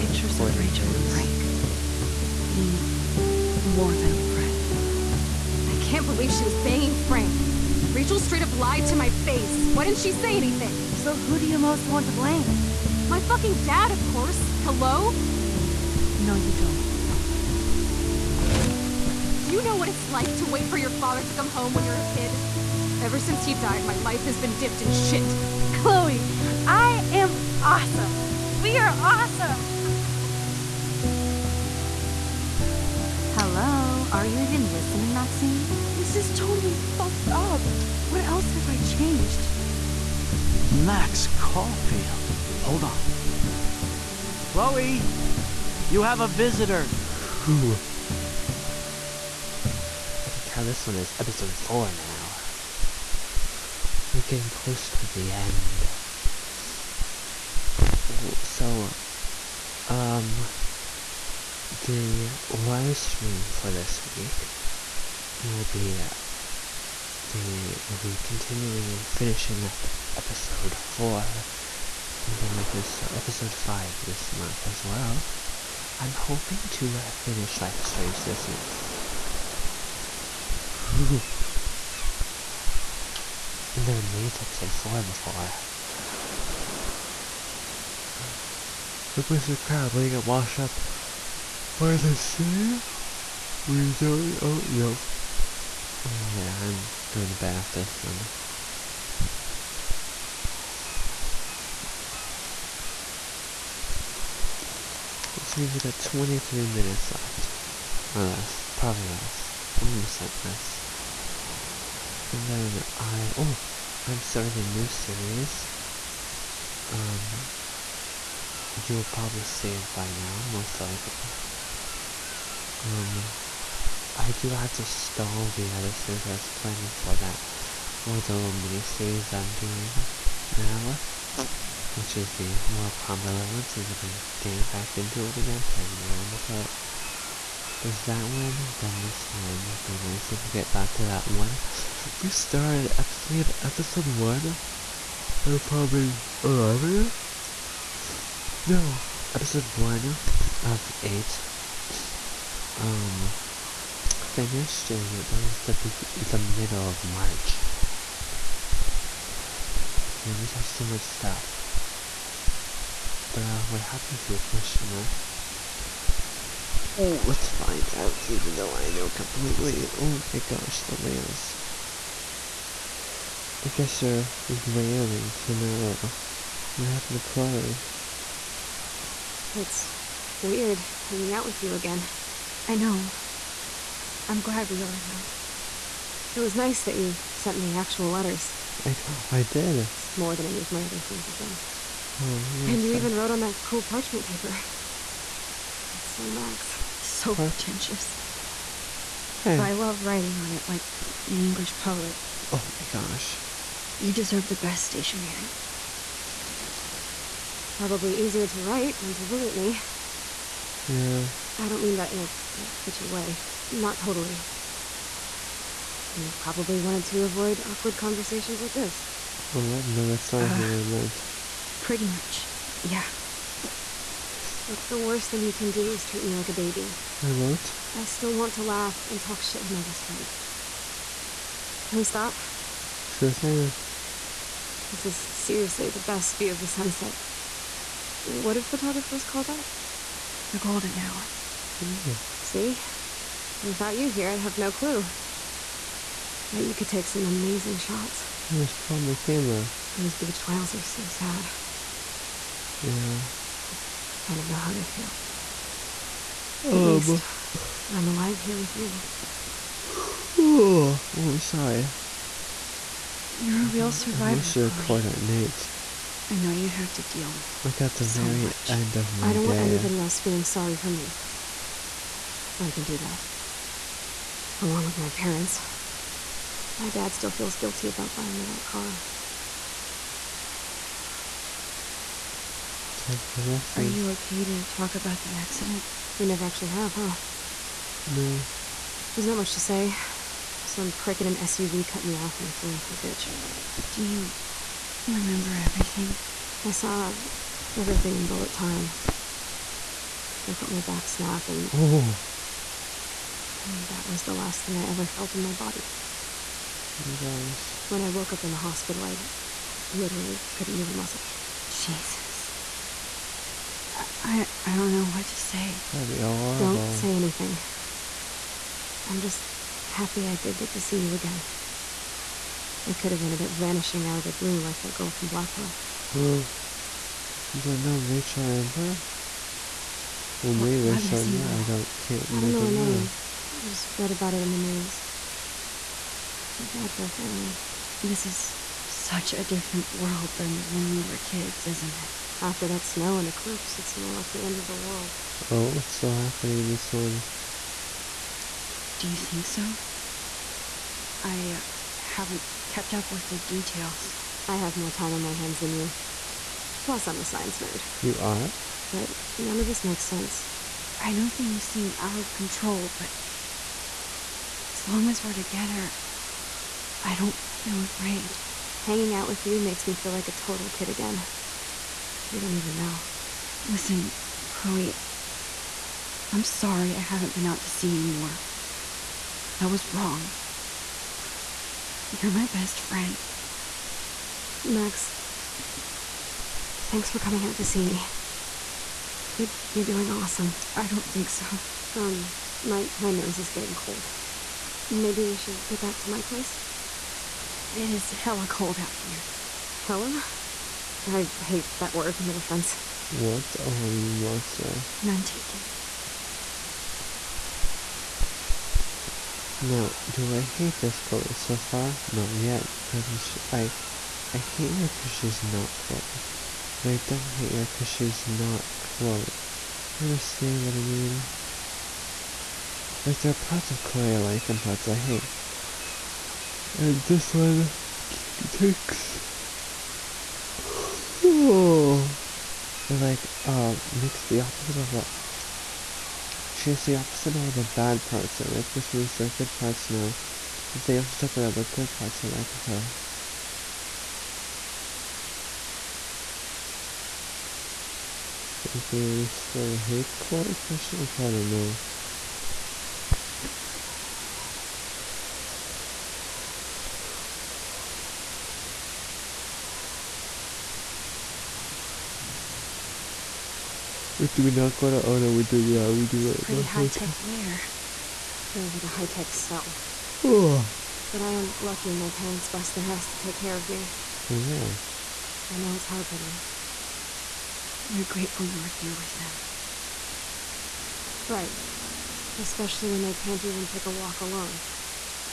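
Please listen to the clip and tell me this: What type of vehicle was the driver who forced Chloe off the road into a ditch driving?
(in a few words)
SUV.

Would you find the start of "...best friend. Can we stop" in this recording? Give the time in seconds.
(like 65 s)
229 s.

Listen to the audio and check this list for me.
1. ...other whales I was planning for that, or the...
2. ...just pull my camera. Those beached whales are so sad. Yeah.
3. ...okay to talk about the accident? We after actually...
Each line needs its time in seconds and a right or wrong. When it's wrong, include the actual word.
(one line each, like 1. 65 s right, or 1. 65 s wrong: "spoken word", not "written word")
1. 125 s wrong: "series", not "whales"
2. 248 s right
3. 284 s wrong: "never", not "after".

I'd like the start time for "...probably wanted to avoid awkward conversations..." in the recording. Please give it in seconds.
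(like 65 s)
216 s.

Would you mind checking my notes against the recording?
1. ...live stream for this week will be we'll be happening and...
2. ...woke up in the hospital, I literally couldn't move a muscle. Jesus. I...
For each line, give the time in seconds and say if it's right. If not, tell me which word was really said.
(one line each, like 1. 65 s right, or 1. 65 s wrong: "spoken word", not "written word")
1. 62 s wrong: "continuing", not "happening"
2. 308 s right.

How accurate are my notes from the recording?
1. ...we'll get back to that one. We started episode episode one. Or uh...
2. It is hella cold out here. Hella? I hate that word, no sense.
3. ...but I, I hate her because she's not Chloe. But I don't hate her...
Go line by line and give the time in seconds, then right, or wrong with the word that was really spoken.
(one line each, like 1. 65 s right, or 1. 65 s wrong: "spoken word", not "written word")
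1. 140 s right
2. 397 s wrong: "offense", not "sense"
3. 412 s right.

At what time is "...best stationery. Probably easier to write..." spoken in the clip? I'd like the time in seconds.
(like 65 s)
204 s.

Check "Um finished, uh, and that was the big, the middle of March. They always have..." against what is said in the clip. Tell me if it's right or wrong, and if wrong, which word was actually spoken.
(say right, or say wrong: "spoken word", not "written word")
right.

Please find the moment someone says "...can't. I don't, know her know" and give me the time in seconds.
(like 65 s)
331 s.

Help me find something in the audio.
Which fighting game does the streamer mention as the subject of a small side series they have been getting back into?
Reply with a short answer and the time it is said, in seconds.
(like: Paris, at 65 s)
Mortal Kombat 11, at 132 s.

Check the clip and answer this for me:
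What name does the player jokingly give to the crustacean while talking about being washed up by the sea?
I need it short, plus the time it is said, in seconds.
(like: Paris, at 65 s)
Mr. Crab, at 89 s.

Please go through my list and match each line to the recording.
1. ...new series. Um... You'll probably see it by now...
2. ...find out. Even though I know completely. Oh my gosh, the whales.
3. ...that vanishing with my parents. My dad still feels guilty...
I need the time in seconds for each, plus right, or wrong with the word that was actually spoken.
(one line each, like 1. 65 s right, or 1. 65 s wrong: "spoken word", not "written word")
1. 114 s right
2. 167 s right
3. 272 s wrong: "along", not "vanishing".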